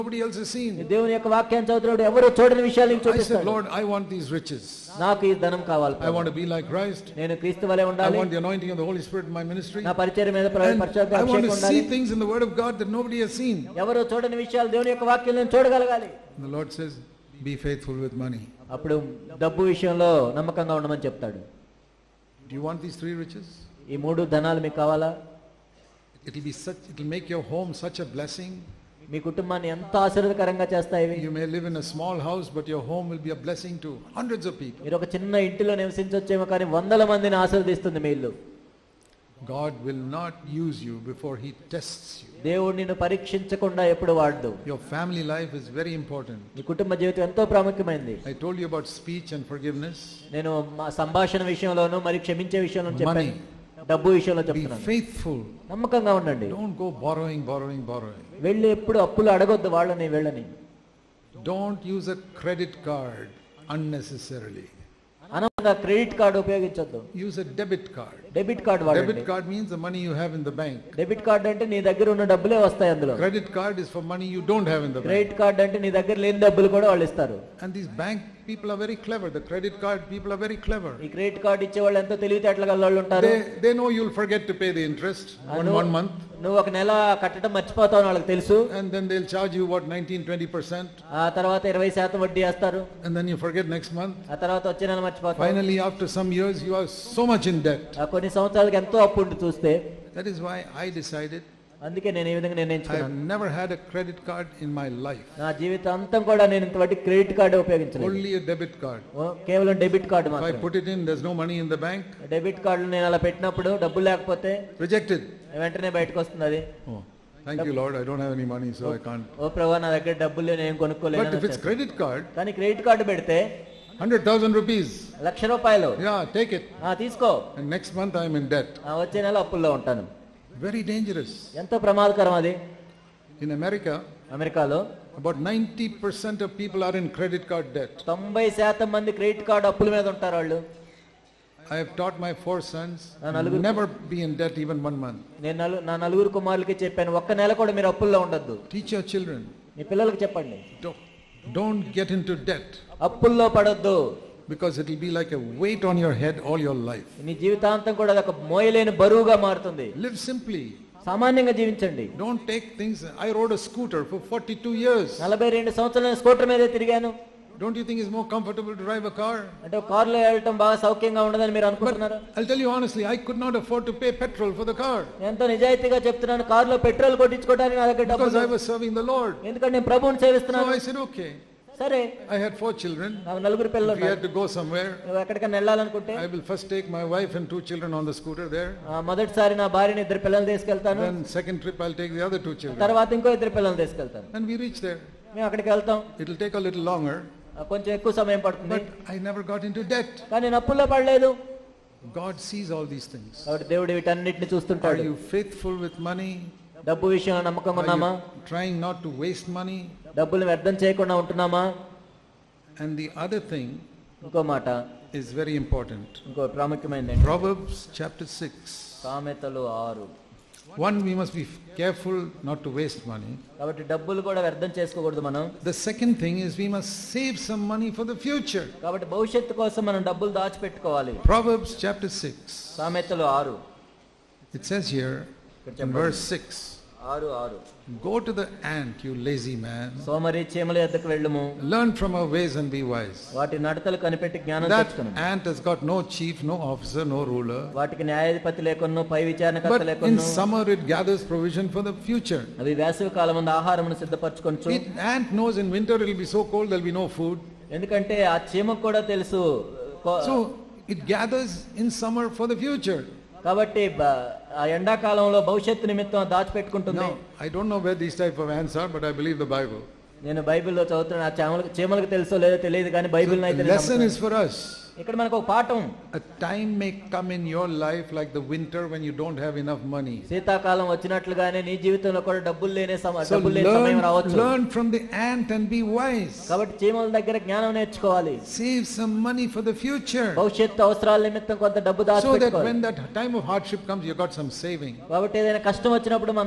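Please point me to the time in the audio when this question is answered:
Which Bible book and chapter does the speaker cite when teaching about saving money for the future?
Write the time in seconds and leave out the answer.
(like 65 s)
217 s.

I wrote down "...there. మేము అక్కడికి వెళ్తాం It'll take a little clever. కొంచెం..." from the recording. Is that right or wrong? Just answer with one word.
wrong.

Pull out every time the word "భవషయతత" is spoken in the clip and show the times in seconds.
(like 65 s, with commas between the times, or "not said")
265 s, 290 s.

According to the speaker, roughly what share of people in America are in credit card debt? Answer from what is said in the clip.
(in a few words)
90%.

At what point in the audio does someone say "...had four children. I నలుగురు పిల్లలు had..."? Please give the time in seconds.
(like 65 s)
182 s.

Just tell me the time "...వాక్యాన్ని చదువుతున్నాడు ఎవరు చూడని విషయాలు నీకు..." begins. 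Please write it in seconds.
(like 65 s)
1 s.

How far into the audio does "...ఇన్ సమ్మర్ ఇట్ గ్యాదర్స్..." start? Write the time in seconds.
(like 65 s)
250 s.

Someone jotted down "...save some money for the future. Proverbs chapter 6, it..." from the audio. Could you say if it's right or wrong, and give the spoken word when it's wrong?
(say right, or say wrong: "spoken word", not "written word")
right.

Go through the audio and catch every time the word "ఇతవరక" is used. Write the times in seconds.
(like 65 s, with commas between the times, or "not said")
106 s.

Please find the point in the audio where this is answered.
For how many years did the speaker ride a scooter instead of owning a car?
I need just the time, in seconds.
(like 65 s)
164 s.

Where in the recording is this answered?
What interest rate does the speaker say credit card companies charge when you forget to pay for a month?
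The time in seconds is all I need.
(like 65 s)
89 s.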